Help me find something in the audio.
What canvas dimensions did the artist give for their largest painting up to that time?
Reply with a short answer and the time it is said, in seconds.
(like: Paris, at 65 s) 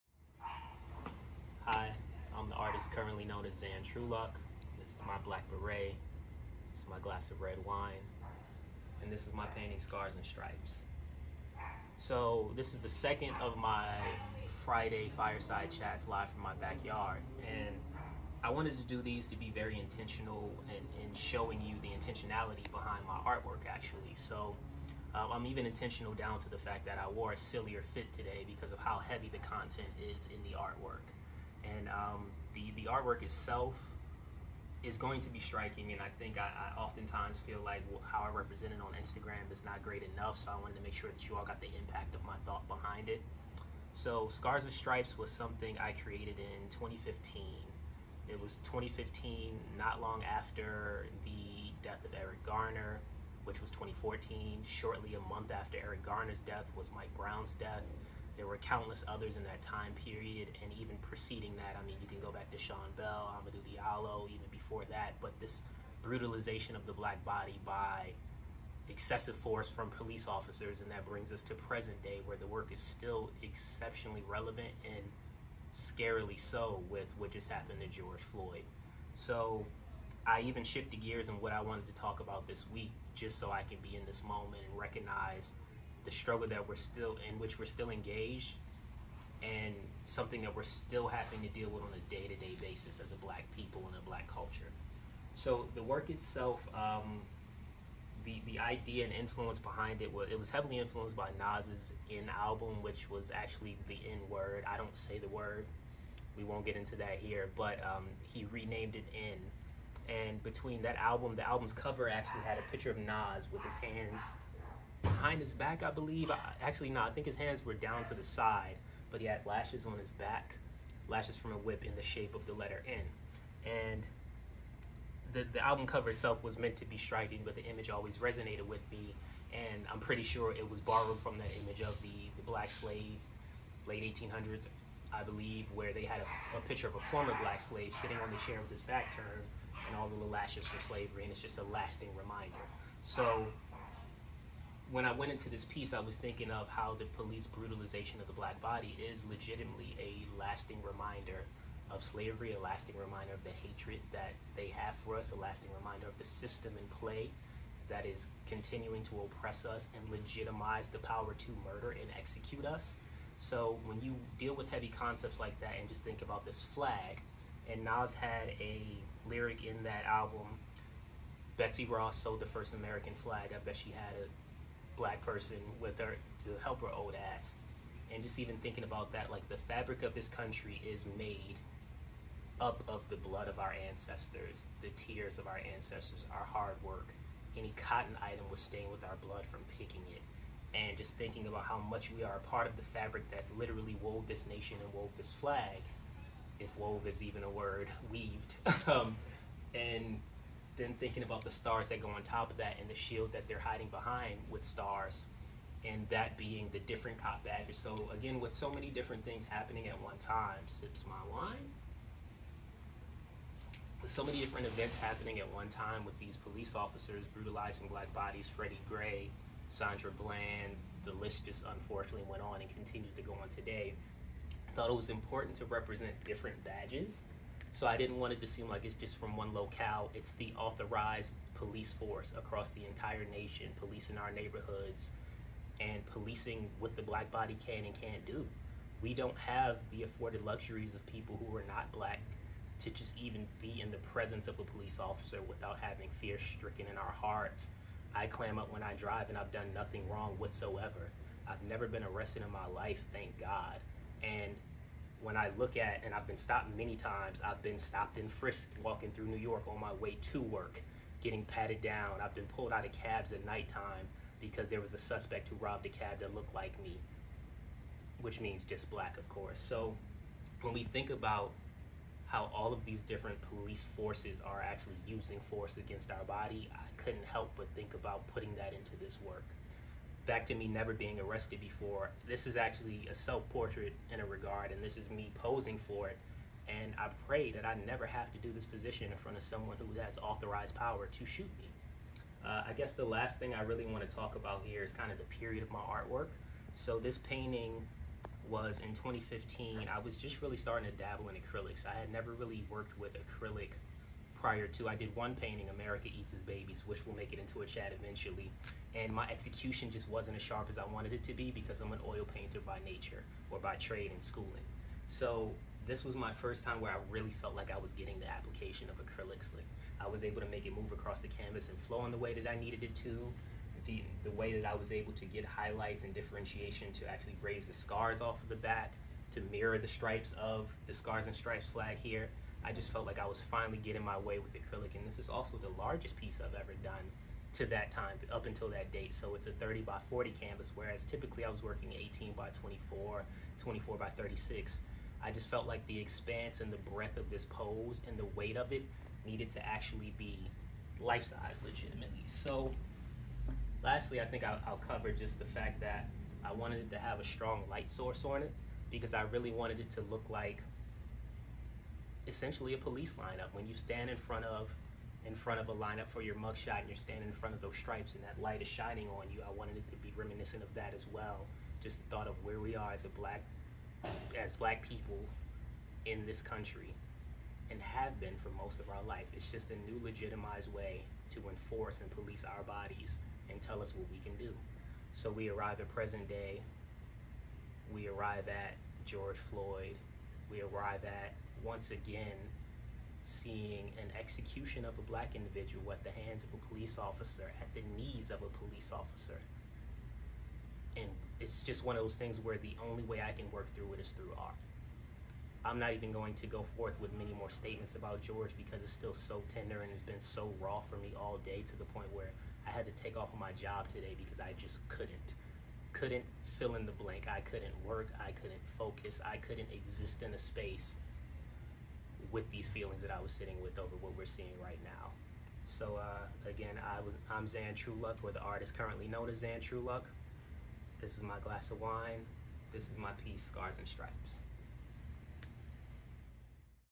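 30 by 40, at 339 s.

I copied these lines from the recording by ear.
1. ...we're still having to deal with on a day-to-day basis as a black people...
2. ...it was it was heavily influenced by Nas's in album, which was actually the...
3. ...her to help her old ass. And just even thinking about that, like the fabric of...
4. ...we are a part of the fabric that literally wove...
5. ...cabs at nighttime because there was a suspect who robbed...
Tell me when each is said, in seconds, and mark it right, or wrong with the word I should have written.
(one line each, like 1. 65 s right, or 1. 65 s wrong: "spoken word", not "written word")
1. 90 s right
2. 100 s right
3. 175 s right
4. 192 s right
5. 262 s right.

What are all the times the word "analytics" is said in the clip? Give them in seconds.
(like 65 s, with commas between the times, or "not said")
not said.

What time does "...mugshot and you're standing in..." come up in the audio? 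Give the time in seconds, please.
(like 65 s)
366 s.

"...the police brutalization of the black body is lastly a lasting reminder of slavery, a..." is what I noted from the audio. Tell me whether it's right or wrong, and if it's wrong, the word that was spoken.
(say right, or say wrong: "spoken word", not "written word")
wrong: "legitimately", not "lastly".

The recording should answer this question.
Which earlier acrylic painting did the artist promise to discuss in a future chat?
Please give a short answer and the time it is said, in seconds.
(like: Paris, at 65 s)
America Eats Its Babies, at 305 s.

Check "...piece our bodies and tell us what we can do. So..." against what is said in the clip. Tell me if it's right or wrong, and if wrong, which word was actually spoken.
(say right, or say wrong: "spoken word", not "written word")
wrong: "police", not "piece".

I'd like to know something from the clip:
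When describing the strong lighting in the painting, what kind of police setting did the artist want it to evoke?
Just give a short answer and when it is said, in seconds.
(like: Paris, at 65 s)
police lineup, at 362 s.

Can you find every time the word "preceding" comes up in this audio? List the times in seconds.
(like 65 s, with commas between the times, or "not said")
60 s.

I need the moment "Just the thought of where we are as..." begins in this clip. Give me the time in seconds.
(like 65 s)
371 s.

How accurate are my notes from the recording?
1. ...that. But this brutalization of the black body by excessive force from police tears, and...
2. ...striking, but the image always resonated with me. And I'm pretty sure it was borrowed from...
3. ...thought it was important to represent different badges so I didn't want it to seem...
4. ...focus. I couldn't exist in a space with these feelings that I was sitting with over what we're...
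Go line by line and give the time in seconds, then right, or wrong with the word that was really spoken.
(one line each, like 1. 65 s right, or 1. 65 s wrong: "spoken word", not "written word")
1. 64 s wrong: "officers", not "tears"
2. 126 s right
3. 224 s right
4. 418 s right.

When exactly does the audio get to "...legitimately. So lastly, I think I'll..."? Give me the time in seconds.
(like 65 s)
351 s.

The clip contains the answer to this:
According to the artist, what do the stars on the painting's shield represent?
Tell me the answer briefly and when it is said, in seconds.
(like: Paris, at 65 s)
cop badges, at 207 s.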